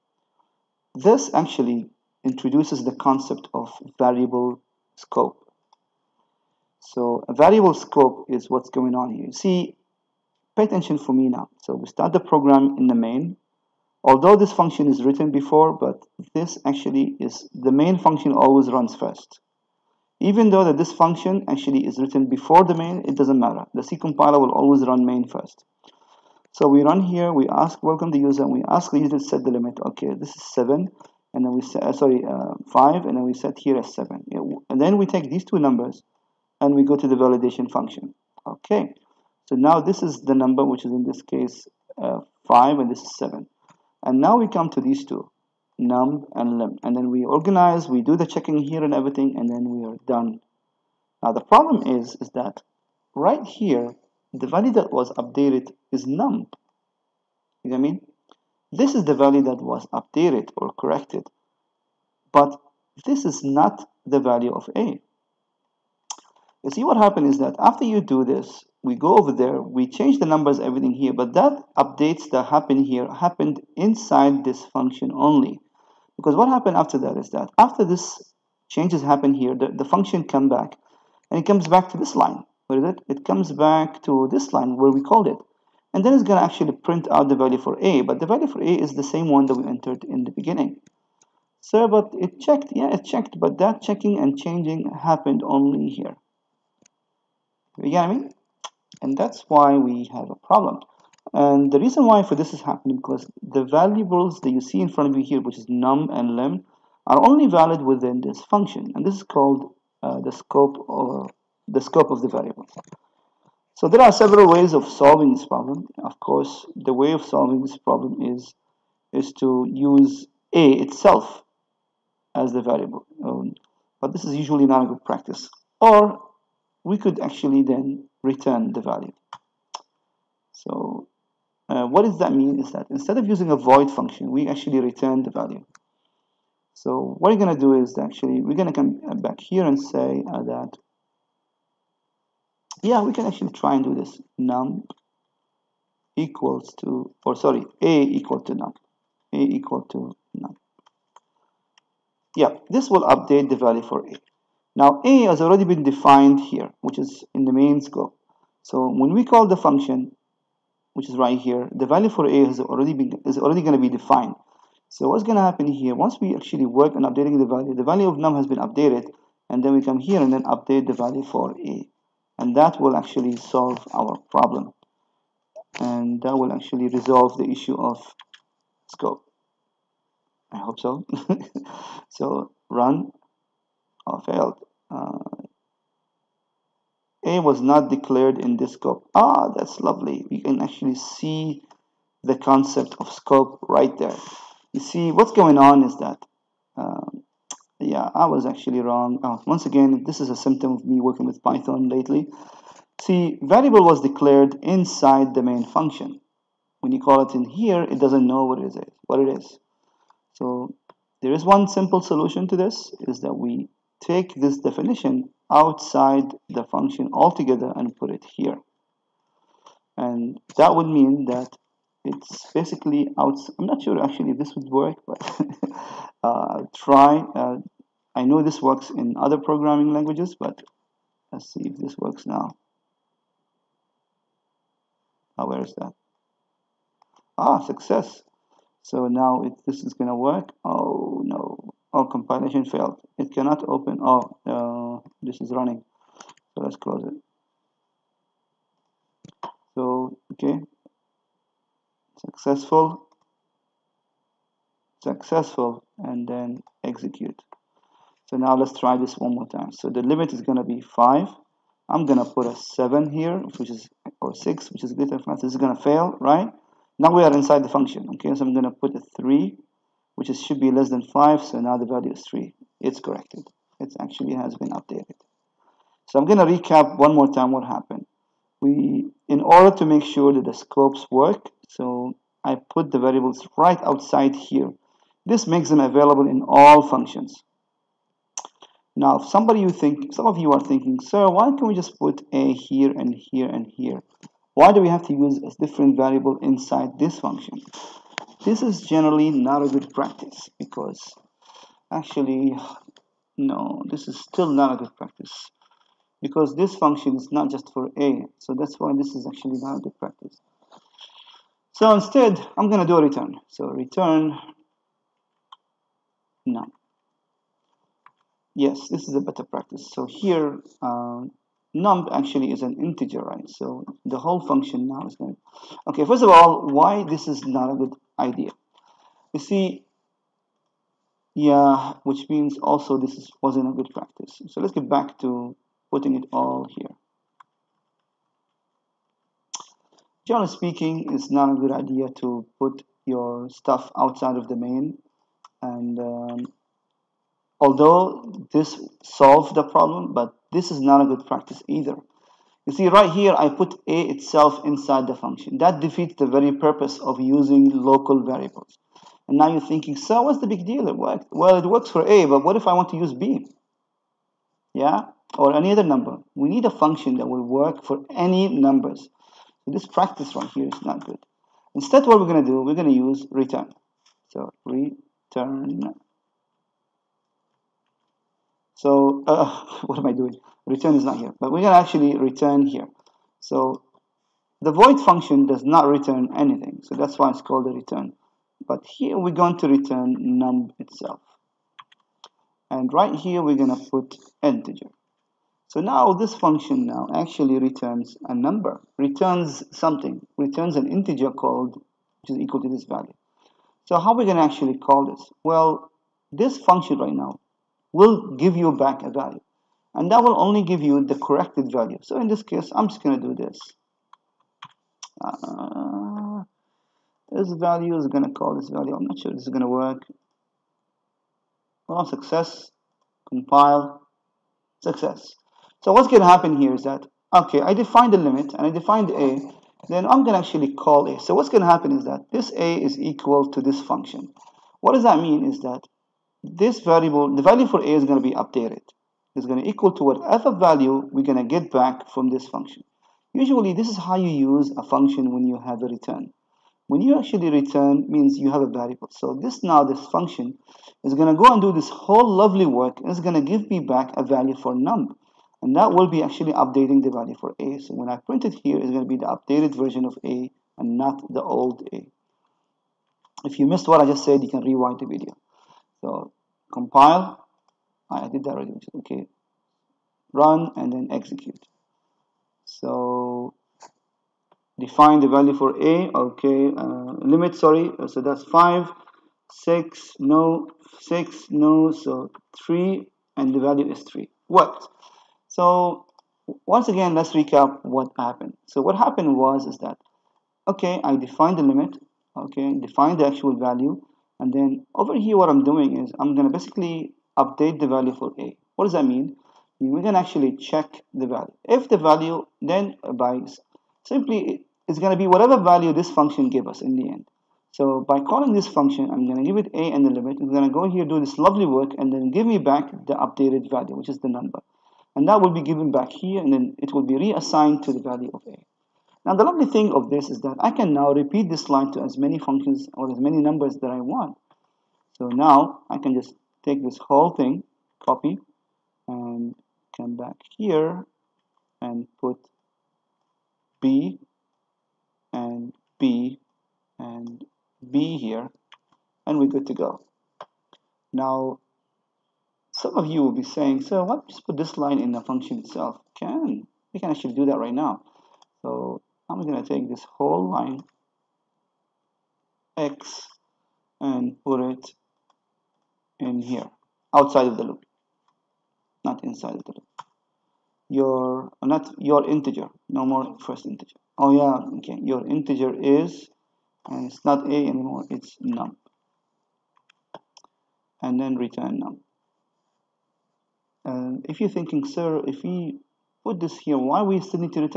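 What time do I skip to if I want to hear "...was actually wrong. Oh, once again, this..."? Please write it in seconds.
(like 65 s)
198 s.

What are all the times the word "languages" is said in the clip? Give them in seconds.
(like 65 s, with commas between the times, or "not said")
229 s.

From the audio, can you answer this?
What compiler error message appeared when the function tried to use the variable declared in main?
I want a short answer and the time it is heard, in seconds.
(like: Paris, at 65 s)
a was not declared in this scope, at 187 s.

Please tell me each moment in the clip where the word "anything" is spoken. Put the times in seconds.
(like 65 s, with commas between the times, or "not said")
386 s.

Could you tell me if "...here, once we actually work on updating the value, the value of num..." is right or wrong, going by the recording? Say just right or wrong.
right.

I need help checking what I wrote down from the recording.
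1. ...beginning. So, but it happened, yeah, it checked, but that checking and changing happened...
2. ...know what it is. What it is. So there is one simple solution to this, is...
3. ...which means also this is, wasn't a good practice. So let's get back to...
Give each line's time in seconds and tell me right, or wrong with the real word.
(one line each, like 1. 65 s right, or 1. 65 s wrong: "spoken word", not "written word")
1. 90 s wrong: "checked", not "happened"
2. 208 s right
3. 332 s right.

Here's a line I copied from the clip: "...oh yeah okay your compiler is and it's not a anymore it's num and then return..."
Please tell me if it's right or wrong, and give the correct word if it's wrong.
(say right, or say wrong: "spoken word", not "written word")
wrong: "integer", not "compiler".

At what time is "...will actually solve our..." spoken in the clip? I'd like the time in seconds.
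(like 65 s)
172 s.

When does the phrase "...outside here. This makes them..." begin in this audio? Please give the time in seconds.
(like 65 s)
283 s.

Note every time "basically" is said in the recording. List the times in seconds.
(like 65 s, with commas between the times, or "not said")
222 s, 496 s.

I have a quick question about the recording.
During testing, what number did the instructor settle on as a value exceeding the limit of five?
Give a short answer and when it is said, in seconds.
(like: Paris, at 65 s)
6, at 264 s.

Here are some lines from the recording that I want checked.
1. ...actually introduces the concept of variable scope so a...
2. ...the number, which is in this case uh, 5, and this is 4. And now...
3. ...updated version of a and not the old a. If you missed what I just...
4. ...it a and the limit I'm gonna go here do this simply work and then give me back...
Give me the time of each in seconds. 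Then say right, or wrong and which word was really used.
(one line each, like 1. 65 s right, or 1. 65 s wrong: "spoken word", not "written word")
1. 1 s right
2. 40 s wrong: "7", not "4"
3. 459 s right
4. 509 s wrong: "lovely", not "simply".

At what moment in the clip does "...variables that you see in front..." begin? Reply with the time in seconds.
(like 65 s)
103 s.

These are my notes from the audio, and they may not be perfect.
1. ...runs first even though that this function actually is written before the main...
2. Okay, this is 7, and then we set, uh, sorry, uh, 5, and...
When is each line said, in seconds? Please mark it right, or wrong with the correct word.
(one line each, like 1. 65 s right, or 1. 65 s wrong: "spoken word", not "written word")
1. 18 s right
2. 29 s right.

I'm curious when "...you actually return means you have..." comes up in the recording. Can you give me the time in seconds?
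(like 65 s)
447 s.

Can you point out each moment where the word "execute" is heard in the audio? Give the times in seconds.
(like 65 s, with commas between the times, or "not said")
256 s, 471 s.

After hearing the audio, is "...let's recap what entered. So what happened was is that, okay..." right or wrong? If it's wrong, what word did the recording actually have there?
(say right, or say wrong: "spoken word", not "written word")
wrong: "happened", not "entered".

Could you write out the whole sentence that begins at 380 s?
Return is not here, but we're gonna actually return here.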